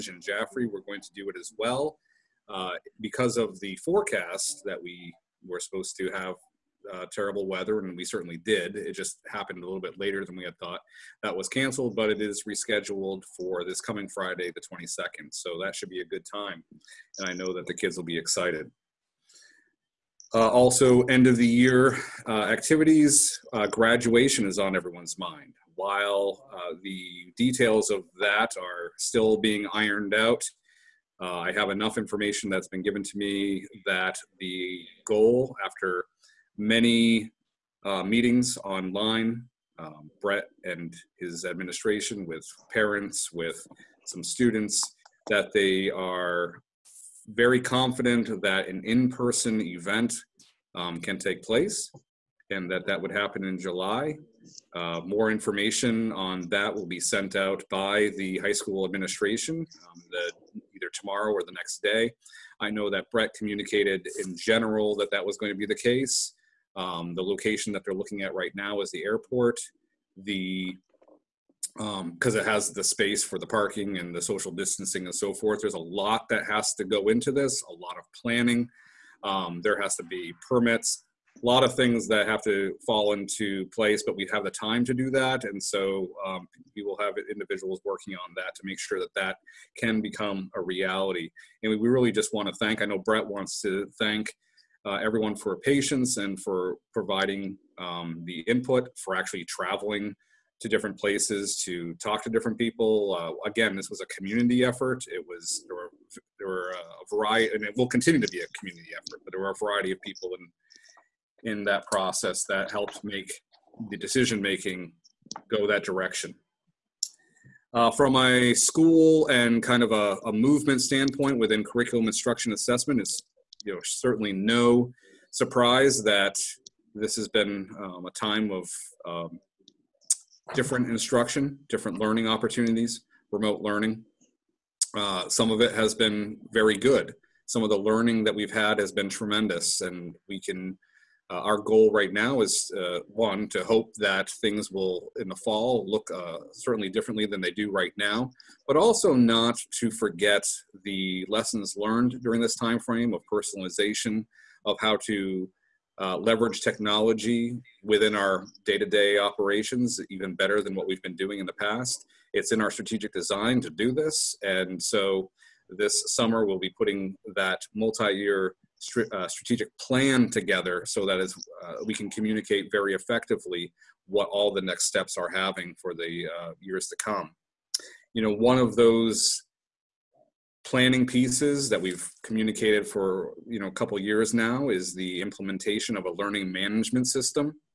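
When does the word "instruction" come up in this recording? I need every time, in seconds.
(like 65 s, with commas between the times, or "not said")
122 s, 130 s.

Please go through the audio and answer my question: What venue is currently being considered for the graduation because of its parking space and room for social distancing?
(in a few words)
The airport.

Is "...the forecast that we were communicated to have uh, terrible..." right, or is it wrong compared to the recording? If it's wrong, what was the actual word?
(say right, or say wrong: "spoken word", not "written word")
wrong: "supposed", not "communicated".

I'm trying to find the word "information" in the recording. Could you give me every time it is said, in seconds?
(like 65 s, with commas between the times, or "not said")
31 s, 55 s.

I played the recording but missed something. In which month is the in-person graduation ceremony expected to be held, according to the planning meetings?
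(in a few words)
July.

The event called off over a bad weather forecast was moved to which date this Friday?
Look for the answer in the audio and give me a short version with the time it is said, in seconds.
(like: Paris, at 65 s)
22nd, at 14 s.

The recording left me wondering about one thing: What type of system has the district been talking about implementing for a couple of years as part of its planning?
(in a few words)
Learning management system.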